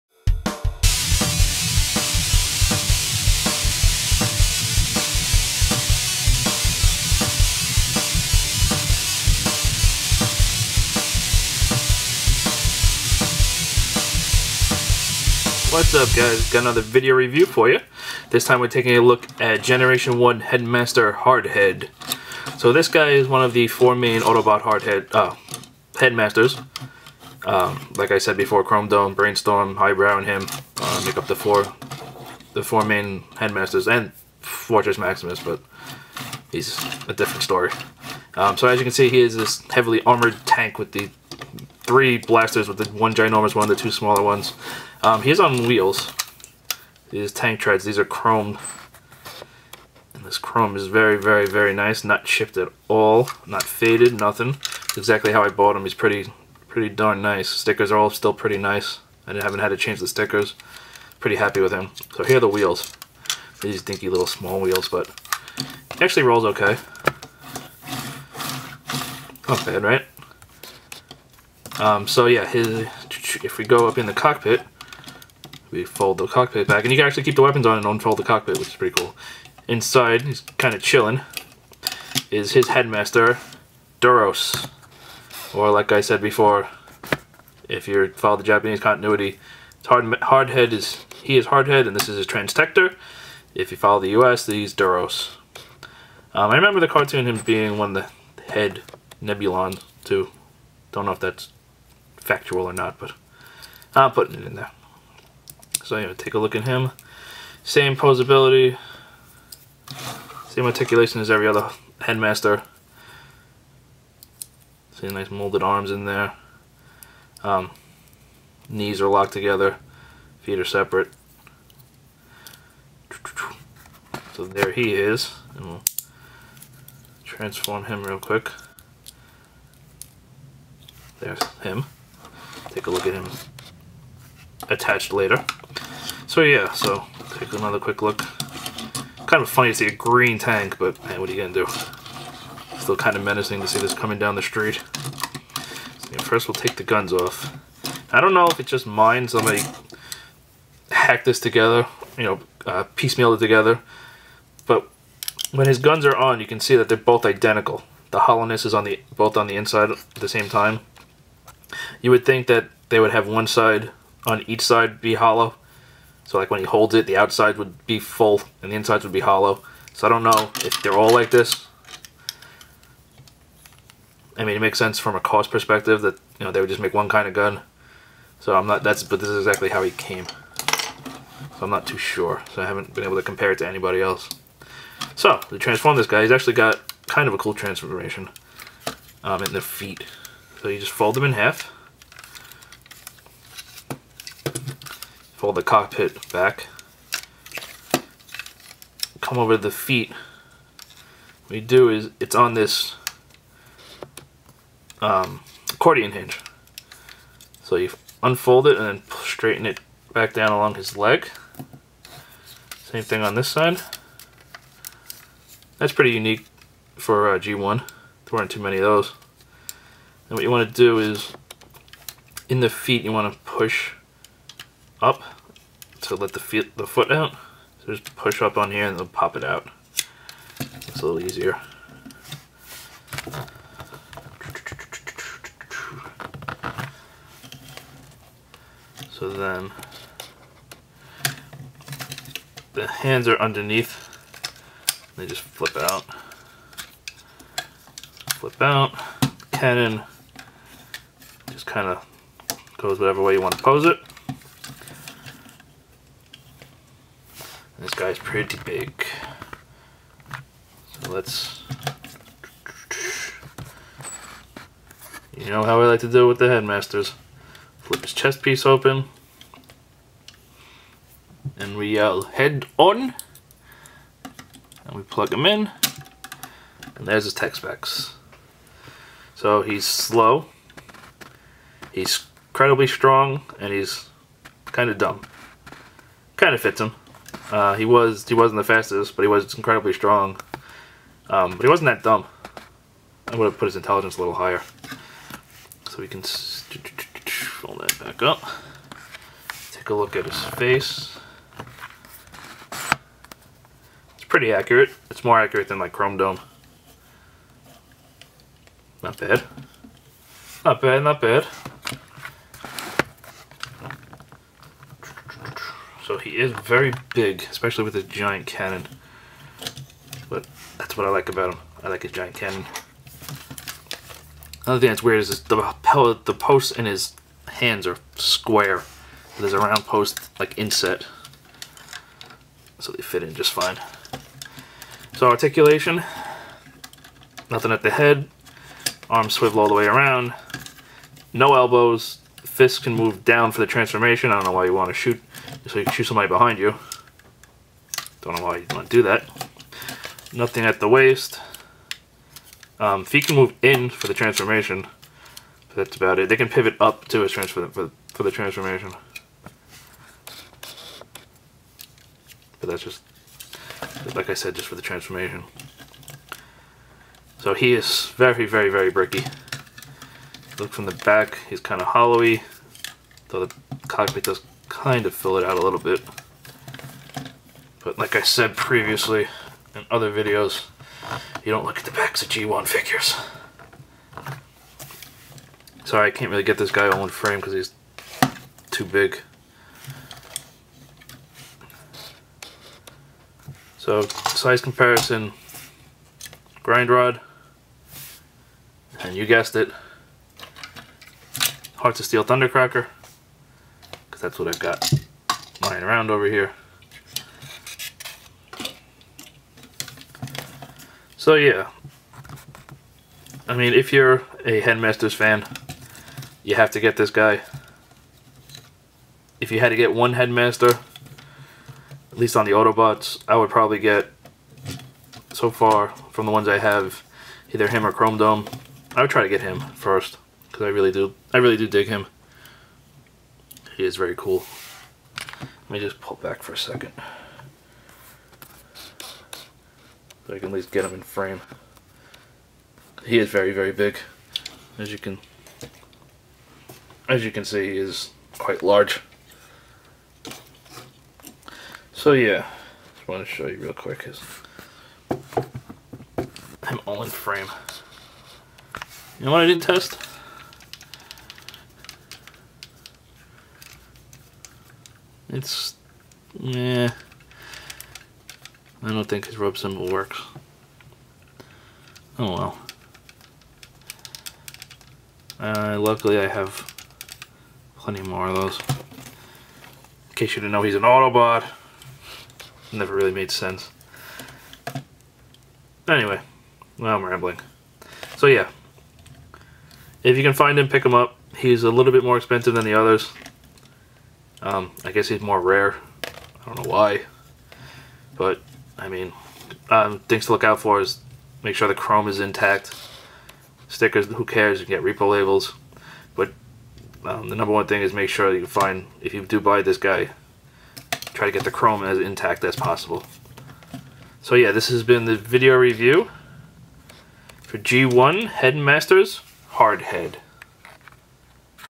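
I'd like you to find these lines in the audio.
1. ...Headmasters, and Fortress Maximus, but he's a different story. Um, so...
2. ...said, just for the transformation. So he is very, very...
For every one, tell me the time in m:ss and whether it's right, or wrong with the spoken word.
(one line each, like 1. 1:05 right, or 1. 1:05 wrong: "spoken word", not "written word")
1. 0:33 right
2. 6:04 right.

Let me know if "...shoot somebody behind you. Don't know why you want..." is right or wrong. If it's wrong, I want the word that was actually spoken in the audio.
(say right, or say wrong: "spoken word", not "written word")
right.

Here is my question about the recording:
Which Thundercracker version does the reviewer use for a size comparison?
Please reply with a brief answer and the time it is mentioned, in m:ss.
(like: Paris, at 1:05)
Hearts of Steel, at 6:41.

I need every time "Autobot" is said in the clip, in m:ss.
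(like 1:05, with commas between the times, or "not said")
0:24, 7:02, 8:00.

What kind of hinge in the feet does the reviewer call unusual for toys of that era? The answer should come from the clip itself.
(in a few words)
Accordion hinge.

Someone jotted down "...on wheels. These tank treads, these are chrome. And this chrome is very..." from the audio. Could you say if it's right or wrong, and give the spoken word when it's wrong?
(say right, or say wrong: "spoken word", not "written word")
right.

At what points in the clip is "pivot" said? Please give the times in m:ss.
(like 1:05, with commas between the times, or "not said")
5:56.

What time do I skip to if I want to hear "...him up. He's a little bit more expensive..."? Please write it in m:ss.
8:10.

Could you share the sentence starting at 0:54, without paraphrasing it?
It's exactly how I bought him.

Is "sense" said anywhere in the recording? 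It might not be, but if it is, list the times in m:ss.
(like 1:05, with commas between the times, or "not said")
2:54, 8:03.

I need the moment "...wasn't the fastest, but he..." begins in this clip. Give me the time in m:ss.
4:48.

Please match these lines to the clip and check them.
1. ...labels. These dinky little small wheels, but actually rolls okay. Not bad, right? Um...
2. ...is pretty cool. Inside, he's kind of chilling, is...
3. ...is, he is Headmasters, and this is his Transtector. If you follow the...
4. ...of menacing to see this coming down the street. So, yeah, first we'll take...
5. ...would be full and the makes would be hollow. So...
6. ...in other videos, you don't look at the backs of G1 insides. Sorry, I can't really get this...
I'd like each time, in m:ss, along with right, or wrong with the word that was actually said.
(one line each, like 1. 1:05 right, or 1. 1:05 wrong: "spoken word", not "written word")
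1. 1:02 wrong: "wheels", not "labels"
2. 1:18 right
3. 1:30 wrong: "Hardhead", not "Headmasters"
4. 2:23 right
5. 2:47 wrong: "insides", not "makes"
6. 6:19 wrong: "figures", not "insides".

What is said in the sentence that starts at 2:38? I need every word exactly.
The hollowness is on the both on the inside at the same time.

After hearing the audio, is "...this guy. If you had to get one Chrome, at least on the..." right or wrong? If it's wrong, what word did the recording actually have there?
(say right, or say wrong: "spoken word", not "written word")
wrong: "Headmaster", not "Chrome".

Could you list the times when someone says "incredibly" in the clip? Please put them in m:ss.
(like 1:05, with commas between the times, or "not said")
4:42, 4:49.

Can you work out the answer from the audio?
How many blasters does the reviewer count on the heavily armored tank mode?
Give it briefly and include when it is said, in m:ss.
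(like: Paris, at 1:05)
3, at 0:41.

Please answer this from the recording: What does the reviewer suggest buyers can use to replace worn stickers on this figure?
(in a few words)
Repo labels.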